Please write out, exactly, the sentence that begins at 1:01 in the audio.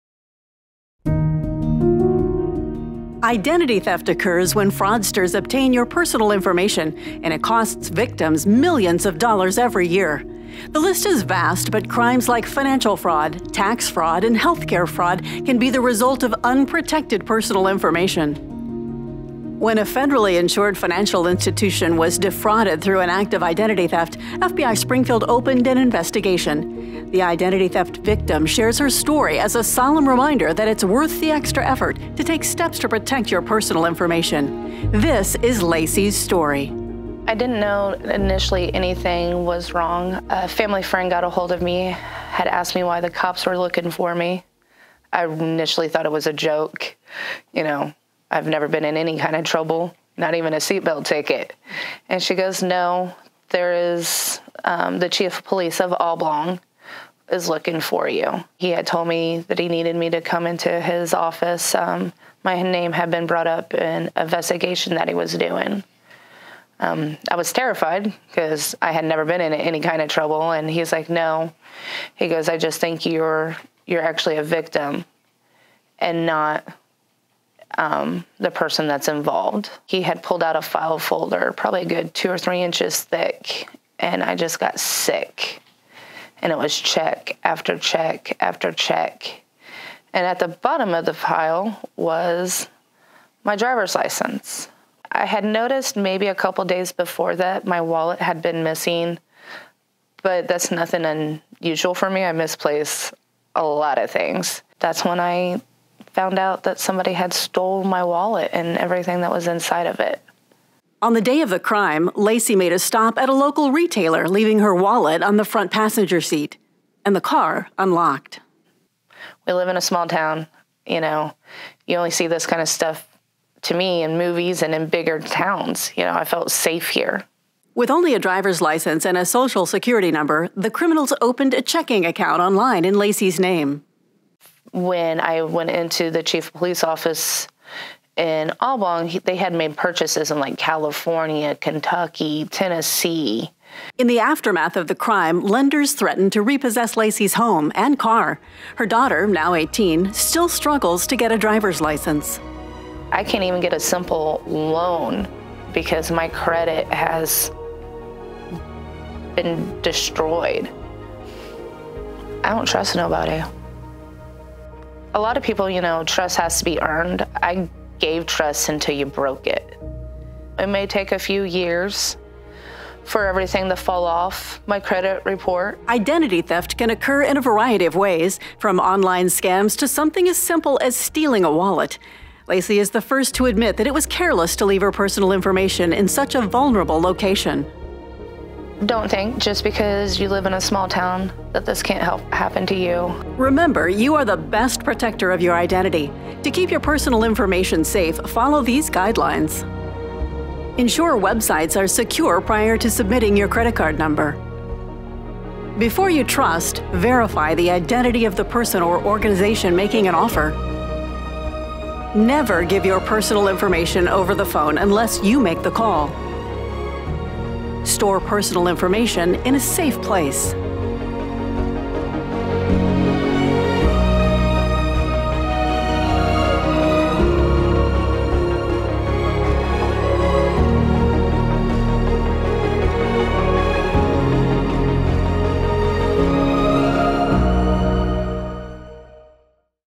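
Um, my name had been brought up in an investigation that he was doing.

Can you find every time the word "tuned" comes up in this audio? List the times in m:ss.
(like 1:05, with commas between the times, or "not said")
not said.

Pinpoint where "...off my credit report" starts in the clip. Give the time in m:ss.
2:54.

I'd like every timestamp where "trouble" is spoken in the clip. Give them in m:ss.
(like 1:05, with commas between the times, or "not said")
0:49, 1:10.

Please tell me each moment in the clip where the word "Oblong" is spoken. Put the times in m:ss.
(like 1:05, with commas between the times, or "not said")
0:55, 2:18.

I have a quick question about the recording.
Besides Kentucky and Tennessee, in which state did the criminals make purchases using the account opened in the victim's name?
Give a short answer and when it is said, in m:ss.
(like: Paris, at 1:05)
California, at 2:20.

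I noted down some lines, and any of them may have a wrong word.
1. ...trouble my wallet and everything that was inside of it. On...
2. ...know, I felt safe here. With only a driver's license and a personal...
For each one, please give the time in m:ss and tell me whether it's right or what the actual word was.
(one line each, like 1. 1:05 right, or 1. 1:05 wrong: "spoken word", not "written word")
1. 1:47 wrong: "stole", not "trouble"
2. 2:06 wrong: "social", not "personal".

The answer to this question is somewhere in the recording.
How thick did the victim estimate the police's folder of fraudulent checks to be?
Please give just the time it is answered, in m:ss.
1:22.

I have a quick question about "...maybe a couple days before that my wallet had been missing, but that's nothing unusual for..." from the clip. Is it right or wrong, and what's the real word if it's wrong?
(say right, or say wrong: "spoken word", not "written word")
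right.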